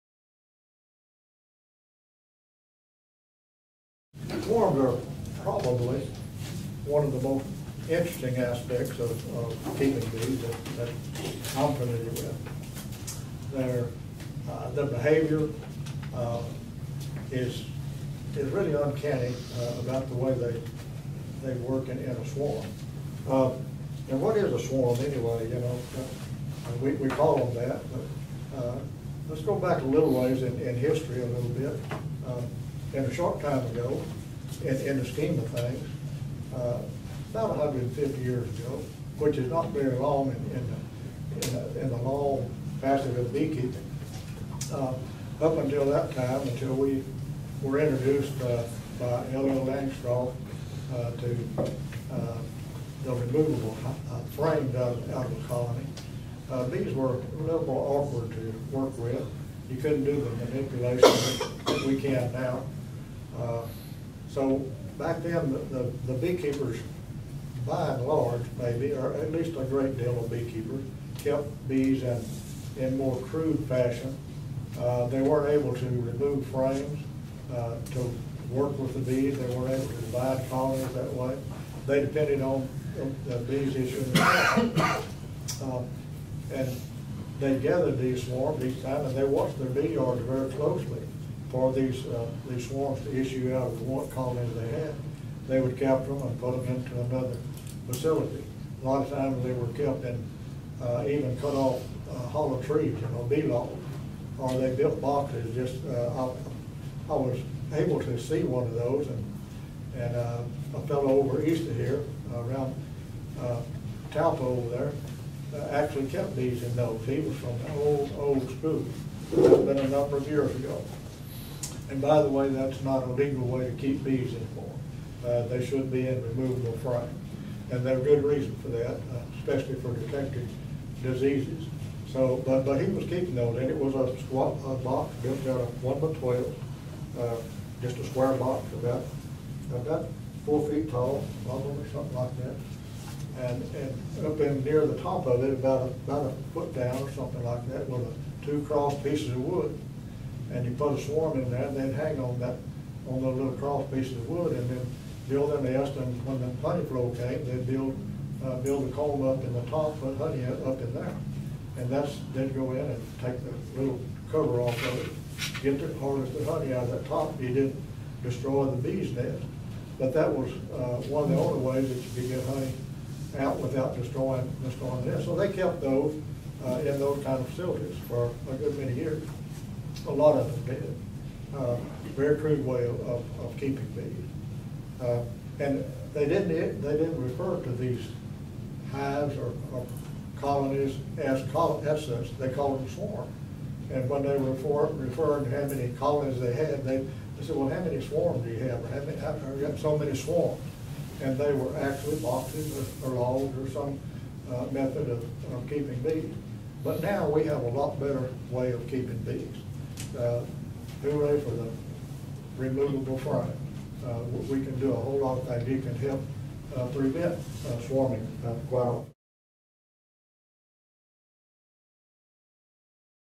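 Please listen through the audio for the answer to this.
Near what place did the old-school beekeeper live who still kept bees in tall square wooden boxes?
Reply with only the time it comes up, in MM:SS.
01:54.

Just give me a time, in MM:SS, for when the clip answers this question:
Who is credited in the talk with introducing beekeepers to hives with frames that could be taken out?
00:49.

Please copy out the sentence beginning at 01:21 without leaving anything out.
They depended on the bees issuing.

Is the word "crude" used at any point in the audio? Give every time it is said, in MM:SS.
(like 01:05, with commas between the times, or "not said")
01:13, 03:02.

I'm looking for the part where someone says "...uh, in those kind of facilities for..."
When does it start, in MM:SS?
02:56.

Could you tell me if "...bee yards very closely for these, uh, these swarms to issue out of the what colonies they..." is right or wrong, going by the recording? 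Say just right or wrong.
right.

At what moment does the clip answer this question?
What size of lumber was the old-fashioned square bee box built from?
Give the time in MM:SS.
02:15.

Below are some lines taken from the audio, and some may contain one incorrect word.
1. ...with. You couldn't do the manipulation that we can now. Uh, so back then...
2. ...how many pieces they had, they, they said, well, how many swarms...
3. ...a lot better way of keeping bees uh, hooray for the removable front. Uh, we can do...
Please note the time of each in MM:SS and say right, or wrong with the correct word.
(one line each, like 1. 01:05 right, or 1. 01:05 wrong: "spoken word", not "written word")
1. 00:58 right
2. 03:15 wrong: "colonies", not "pieces"
3. 03:27 right.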